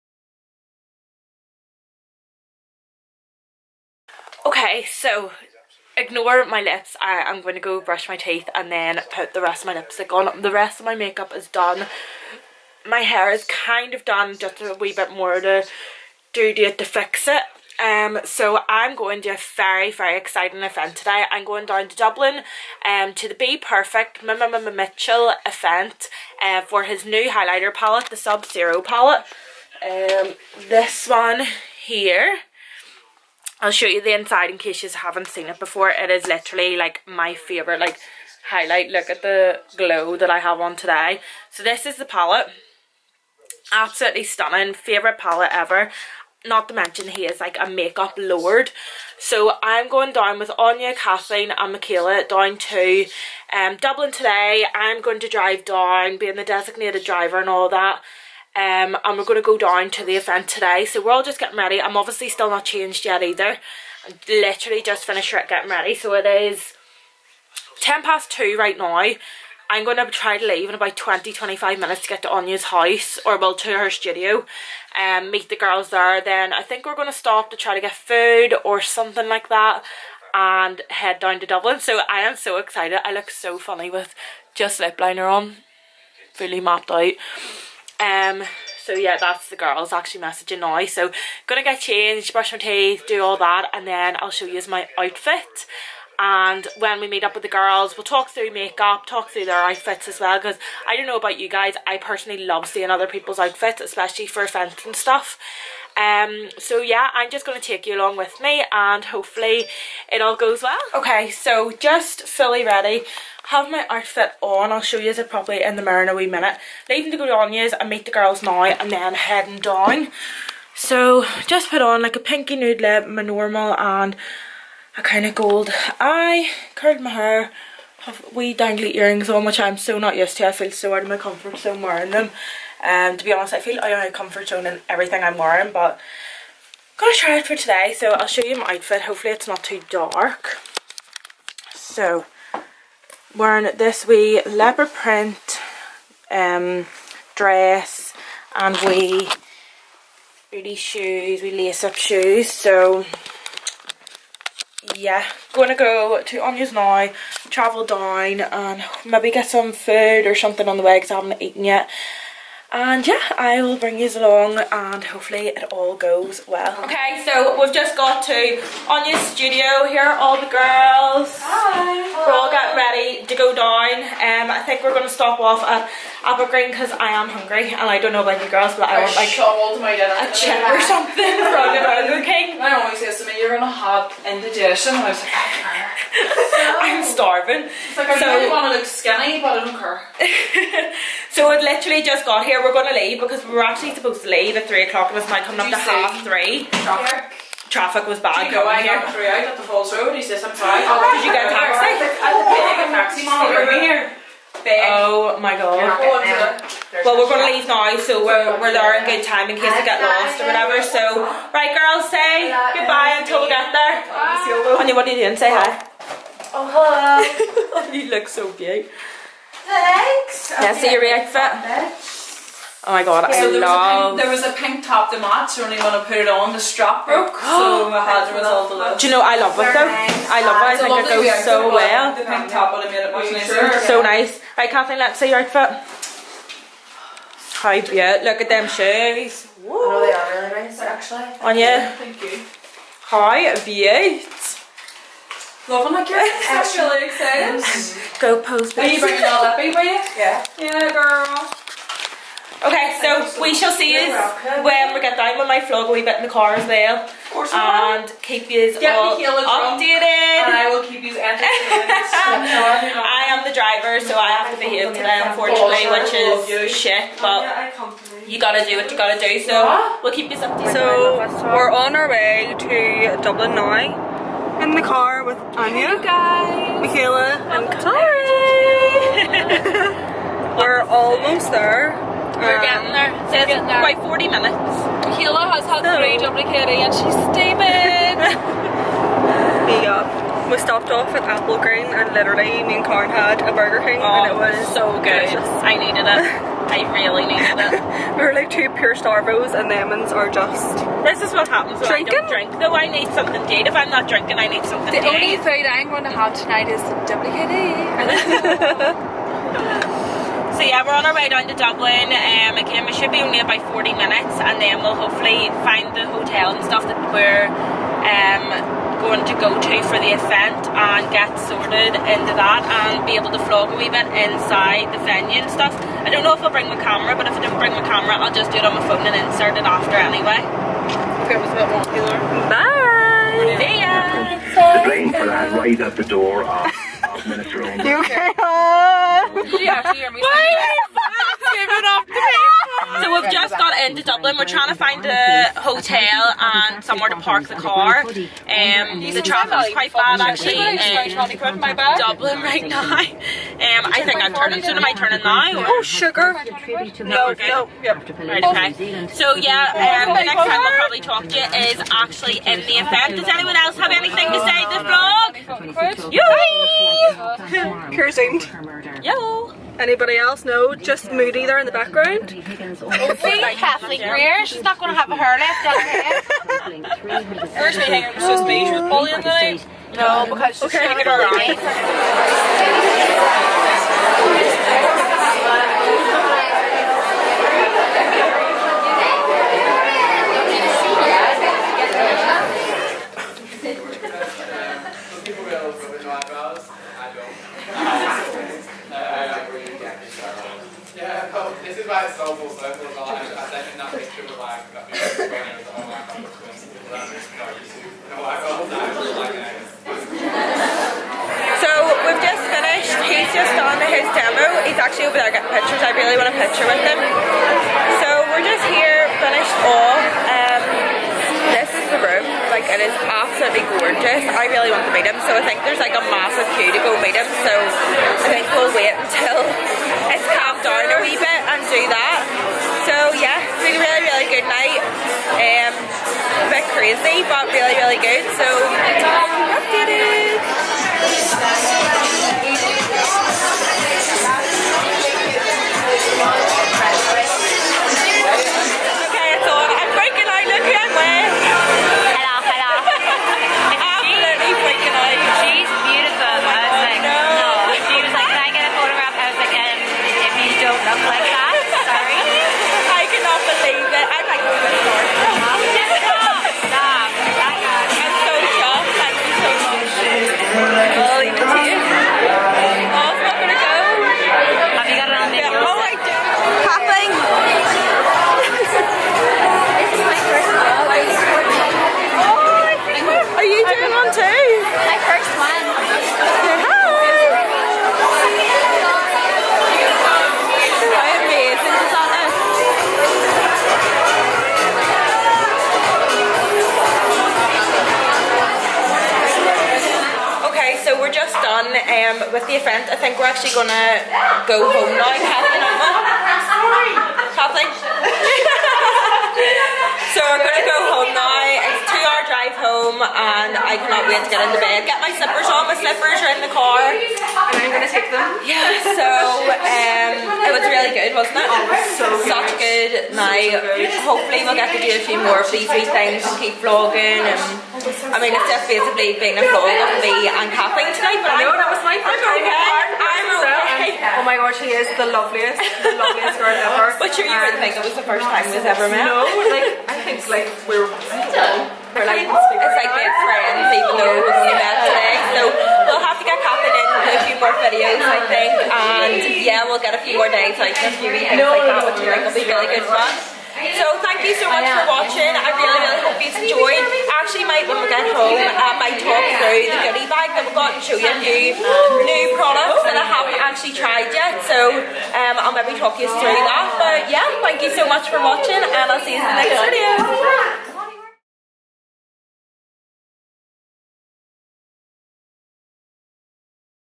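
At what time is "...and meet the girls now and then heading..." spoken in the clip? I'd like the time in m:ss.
1:57.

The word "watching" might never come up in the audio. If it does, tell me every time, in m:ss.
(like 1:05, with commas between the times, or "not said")
9:14, 9:28.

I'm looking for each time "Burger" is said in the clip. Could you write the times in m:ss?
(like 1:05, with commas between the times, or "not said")
3:01, 4:53.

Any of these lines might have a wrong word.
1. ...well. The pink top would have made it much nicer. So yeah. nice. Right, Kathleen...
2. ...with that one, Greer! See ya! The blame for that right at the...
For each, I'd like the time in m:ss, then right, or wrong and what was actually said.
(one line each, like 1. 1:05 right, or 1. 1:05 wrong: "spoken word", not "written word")
1. 3:51 right
2. 5:31 wrong: "Bye", not "Greer".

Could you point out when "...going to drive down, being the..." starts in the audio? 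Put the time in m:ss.
0:55.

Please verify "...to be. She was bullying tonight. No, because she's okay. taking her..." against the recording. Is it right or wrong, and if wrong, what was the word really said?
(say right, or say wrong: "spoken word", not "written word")
right.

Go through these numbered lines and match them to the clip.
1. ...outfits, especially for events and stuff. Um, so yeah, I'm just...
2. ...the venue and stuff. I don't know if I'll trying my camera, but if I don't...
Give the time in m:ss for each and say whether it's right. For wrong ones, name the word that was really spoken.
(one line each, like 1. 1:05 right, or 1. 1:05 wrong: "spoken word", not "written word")
1. 1:43 right
2. 5:24 wrong: "bring", not "trying".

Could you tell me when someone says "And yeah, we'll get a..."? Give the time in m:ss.
9:08.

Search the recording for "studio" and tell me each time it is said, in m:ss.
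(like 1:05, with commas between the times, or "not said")
1:13, 2:49.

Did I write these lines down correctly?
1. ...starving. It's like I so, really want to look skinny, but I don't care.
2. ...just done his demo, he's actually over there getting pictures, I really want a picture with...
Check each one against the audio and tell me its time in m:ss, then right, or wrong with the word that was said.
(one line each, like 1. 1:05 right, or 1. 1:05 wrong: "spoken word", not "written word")
1. 3:07 right
2. 6:53 right.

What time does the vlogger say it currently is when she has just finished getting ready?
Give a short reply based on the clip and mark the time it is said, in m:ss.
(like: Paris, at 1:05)
10 past 2, at 1:07.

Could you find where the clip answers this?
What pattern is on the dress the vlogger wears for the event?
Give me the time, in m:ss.
2:24.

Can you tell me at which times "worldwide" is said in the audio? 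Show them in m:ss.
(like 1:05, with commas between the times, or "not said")
not said.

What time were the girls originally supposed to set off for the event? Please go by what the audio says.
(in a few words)
3 o'clock.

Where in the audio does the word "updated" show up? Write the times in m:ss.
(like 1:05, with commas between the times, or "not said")
4:19, 4:30, 7:18.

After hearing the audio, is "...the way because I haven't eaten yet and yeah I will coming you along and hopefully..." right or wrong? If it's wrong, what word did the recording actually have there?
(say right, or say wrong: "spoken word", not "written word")
wrong: "bring", not "coming".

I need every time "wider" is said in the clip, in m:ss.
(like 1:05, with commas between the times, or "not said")
not said.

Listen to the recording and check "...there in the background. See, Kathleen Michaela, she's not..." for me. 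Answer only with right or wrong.
wrong.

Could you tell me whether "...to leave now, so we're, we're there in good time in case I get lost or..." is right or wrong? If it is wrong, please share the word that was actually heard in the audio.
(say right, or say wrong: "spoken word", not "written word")
right.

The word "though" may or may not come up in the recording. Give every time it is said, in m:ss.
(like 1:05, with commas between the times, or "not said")
3:49, 5:02.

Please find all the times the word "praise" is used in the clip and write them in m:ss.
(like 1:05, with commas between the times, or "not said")
not said.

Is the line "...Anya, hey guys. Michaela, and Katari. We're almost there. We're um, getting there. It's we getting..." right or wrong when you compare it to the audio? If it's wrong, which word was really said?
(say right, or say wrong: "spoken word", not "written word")
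right.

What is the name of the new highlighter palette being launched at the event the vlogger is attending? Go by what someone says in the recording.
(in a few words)
Sub-Zero.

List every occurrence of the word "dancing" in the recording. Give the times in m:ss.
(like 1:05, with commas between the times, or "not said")
not said.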